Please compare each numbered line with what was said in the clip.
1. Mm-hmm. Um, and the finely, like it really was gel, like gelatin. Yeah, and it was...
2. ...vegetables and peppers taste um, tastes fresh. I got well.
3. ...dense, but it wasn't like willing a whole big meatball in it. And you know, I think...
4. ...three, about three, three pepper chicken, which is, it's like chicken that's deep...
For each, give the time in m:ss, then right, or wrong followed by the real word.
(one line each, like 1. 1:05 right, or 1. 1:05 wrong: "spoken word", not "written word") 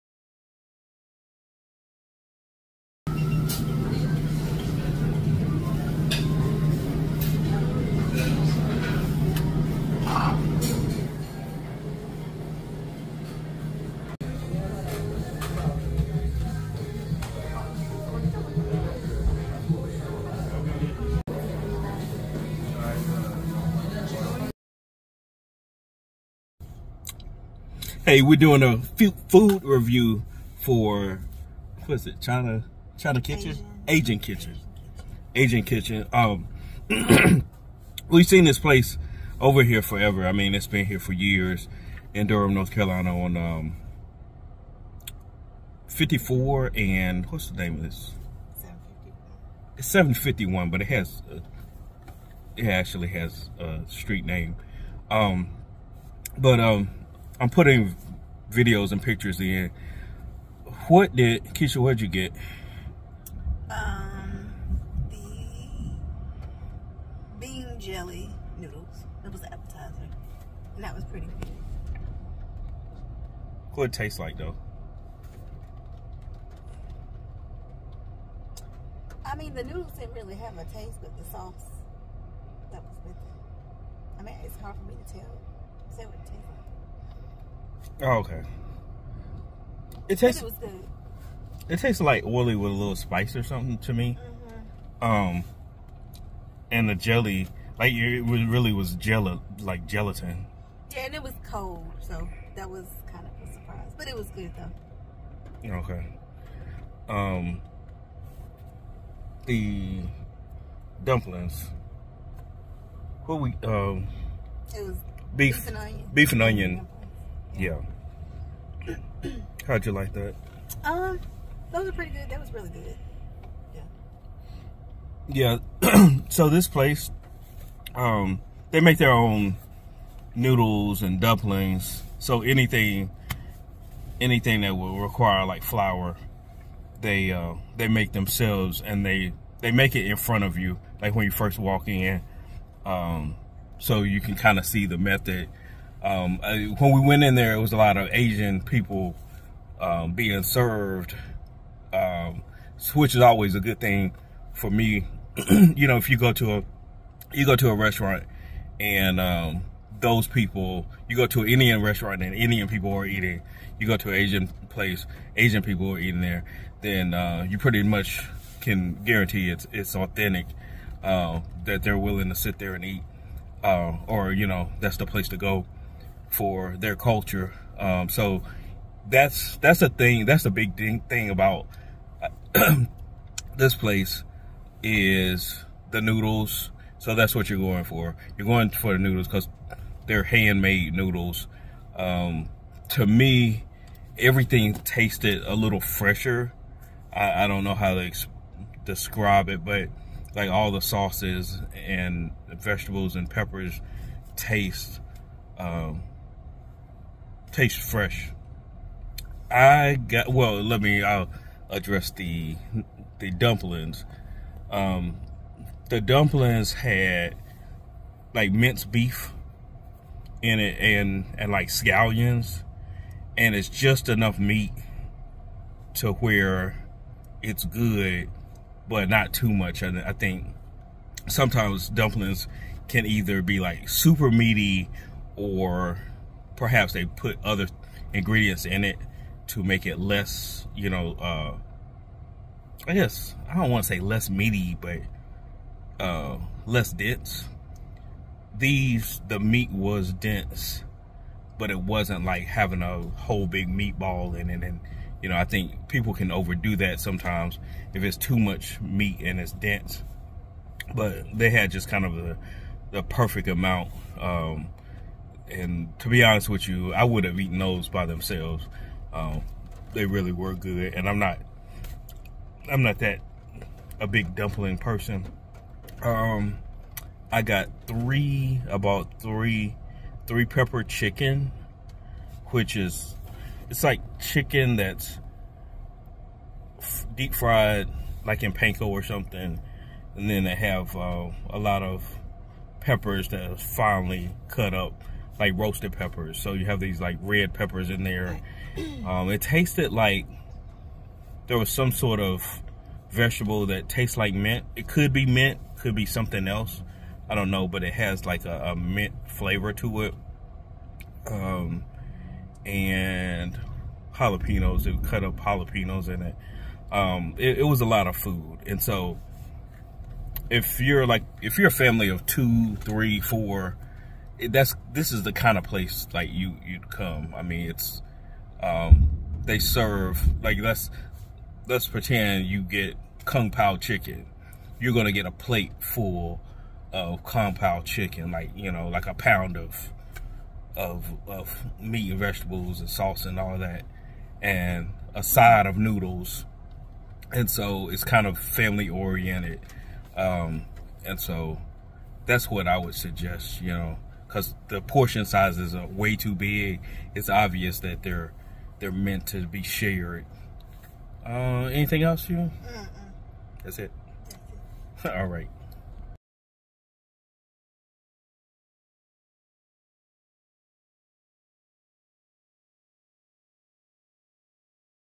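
1. 1:34 wrong: "jelly", not "finely"
2. 3:22 right
3. 4:10 wrong: "having", not "willing"
4. 4:37 right.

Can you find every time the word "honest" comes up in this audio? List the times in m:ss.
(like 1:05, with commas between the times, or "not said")
4:26.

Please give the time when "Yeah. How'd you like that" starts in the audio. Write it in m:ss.
1:57.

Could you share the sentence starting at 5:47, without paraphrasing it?
And so it's kind of family oriented.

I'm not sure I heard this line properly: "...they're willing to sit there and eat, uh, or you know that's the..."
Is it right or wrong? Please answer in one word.
right.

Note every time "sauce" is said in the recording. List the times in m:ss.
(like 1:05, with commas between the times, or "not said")
1:21, 3:20, 5:42.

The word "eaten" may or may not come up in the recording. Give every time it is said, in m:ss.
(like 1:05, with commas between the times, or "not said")
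4:27.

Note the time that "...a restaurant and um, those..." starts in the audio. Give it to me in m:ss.
2:37.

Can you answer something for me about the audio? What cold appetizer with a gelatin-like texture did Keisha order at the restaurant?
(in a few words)
Bean jelly noodles.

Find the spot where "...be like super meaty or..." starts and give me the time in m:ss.
3:53.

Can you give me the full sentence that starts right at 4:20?
But they had just kind of the the perfect amount.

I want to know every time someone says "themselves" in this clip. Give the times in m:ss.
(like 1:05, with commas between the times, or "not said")
2:18, 4:28.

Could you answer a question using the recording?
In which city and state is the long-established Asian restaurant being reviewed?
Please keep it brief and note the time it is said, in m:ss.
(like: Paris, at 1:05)
Durham, North Carolina, at 0:42.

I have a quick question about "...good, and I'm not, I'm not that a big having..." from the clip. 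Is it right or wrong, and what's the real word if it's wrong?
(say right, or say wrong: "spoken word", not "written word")
wrong: "dumpling", not "having".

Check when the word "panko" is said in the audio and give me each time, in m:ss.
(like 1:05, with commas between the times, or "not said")
4:48.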